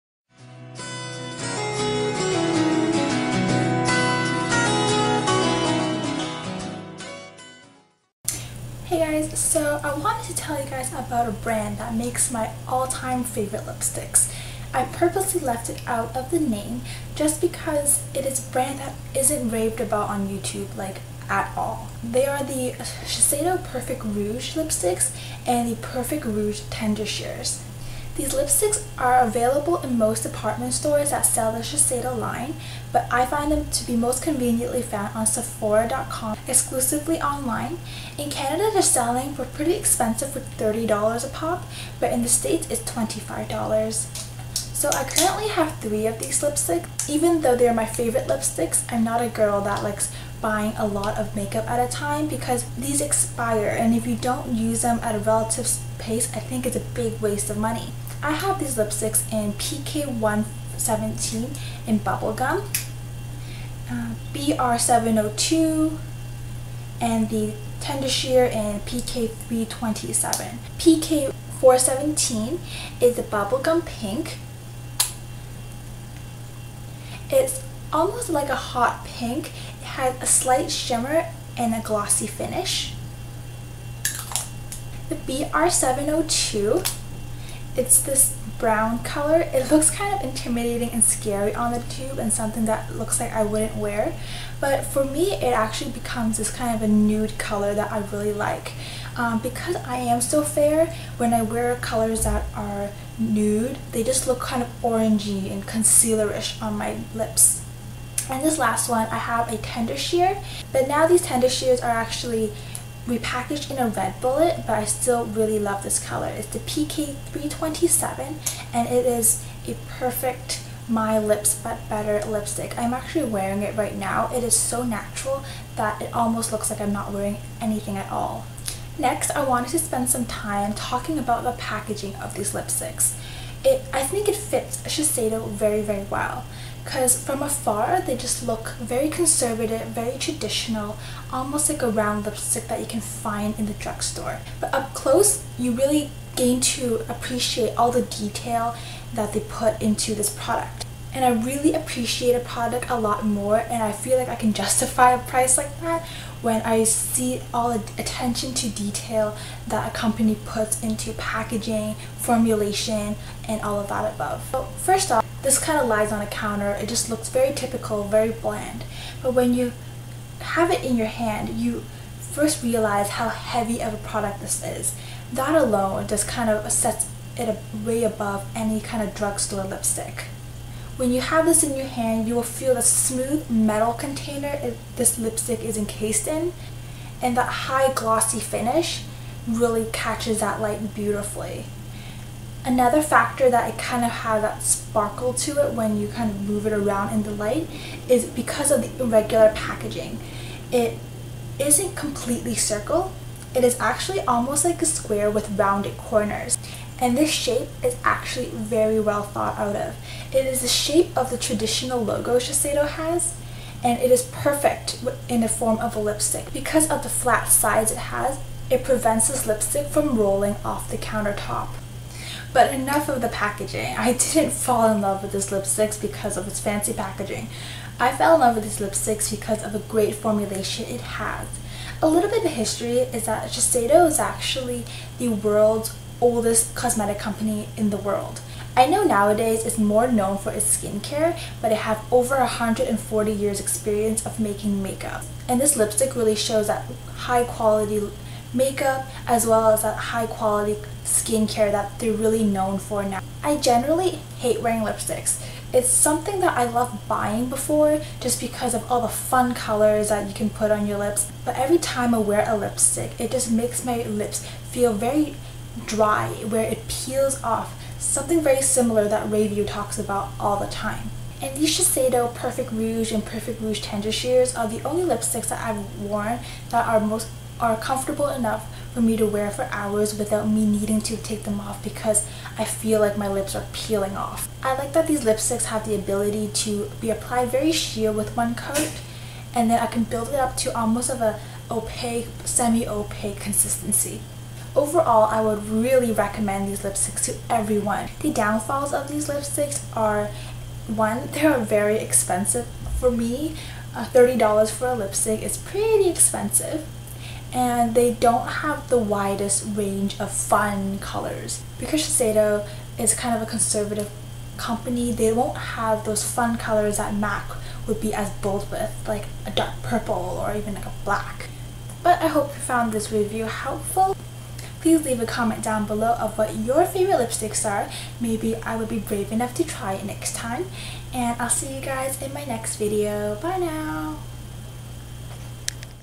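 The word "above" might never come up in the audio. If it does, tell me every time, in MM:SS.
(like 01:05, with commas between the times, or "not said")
02:44, 02:58.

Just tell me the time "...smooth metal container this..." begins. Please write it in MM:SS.
03:02.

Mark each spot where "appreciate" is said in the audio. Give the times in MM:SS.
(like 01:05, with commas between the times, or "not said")
02:27, 02:31.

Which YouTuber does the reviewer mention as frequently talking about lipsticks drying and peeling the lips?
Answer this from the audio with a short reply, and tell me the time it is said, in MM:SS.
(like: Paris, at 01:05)
Rayview, at 04:29.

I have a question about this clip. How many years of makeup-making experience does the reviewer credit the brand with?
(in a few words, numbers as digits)
over 140 years.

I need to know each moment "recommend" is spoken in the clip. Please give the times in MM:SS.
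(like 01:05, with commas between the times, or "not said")
04:56.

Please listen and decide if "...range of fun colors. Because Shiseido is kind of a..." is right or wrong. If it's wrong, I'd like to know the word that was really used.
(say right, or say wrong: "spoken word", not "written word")
right.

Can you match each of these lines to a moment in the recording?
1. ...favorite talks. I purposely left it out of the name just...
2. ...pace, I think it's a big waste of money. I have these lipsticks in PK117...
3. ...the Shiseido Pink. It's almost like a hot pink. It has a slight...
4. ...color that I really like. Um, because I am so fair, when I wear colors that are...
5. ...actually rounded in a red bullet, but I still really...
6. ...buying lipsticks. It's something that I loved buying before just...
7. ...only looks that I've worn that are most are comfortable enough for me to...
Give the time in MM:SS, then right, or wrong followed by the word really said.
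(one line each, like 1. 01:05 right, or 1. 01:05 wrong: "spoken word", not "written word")
1. 00:13 wrong: "lipsticks", not "talks"
2. 00:55 right
3. 01:13 wrong: "Bubblegum", not "Shiseido"
4. 01:37 right
5. 01:51 wrong: "repackaged", not "rounded"
6. 04:14 wrong: "wearing", not "buying"
7. 04:34 wrong: "lipsticks", not "looks".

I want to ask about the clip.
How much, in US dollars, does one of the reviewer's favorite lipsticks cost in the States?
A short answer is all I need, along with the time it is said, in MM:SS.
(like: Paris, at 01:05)
$25, at 00:42.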